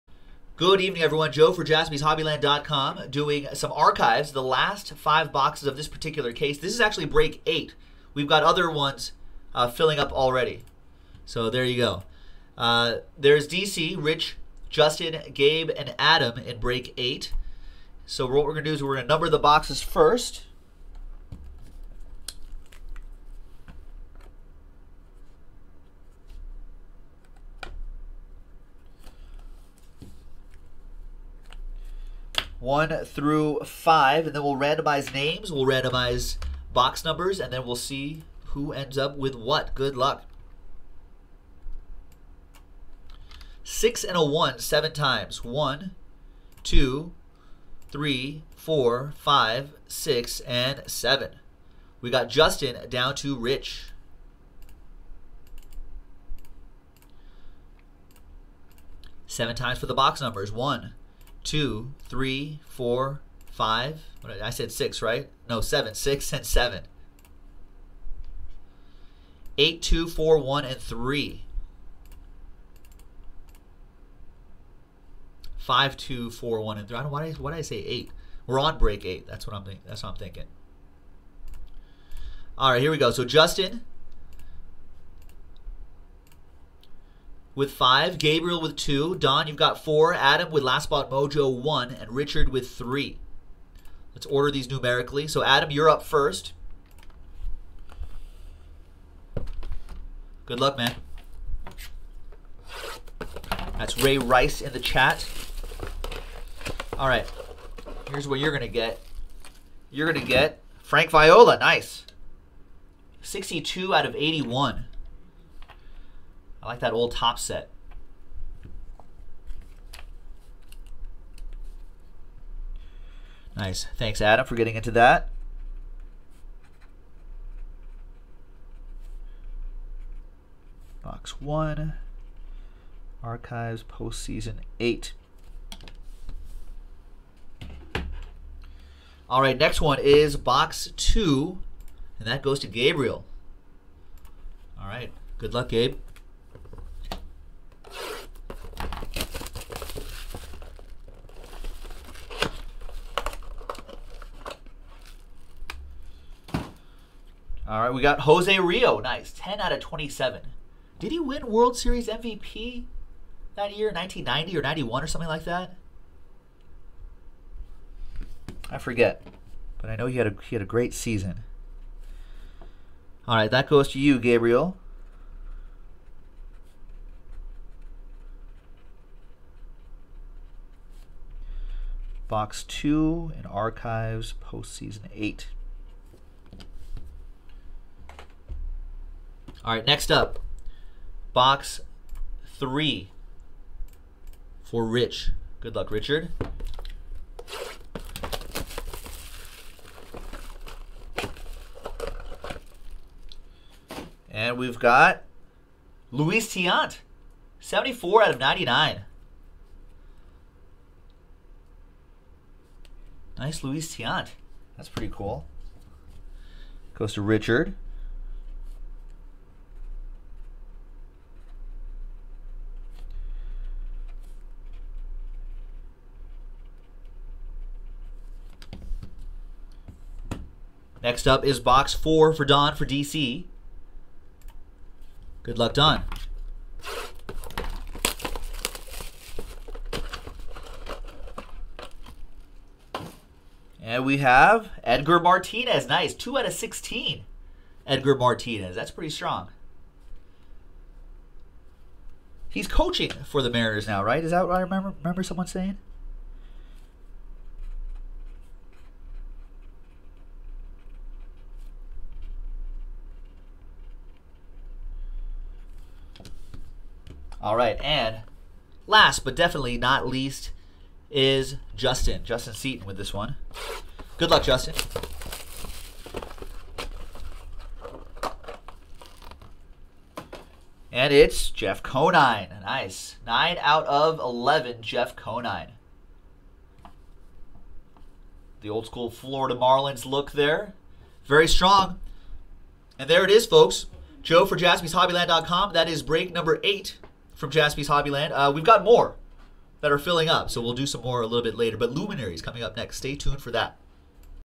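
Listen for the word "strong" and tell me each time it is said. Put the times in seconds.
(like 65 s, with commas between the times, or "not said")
249 s, 291 s.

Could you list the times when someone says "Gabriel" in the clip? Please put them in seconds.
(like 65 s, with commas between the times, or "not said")
88 s, 142 s, 174 s.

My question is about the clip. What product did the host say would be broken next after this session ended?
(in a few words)
Luminary.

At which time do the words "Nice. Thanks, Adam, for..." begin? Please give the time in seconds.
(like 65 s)
123 s.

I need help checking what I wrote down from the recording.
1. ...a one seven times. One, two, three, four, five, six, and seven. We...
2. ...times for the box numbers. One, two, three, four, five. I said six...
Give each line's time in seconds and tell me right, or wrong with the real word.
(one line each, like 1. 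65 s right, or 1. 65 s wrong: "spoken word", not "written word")
1. 44 s right
2. 59 s right.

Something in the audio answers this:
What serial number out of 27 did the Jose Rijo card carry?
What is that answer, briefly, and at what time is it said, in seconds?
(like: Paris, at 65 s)
10, at 159 s.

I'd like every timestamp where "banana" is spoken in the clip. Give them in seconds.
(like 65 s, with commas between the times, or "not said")
not said.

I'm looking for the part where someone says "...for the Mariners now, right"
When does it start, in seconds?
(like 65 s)
253 s.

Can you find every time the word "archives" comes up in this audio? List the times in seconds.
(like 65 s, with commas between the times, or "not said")
3 s, 133 s, 183 s.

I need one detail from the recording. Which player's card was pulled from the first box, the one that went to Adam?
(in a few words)
Frank Viola.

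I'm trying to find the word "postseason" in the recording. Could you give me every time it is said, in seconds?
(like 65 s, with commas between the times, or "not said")
133 s, 184 s.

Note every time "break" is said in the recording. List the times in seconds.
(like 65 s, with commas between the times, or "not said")
7 s, 16 s, 78 s, 296 s.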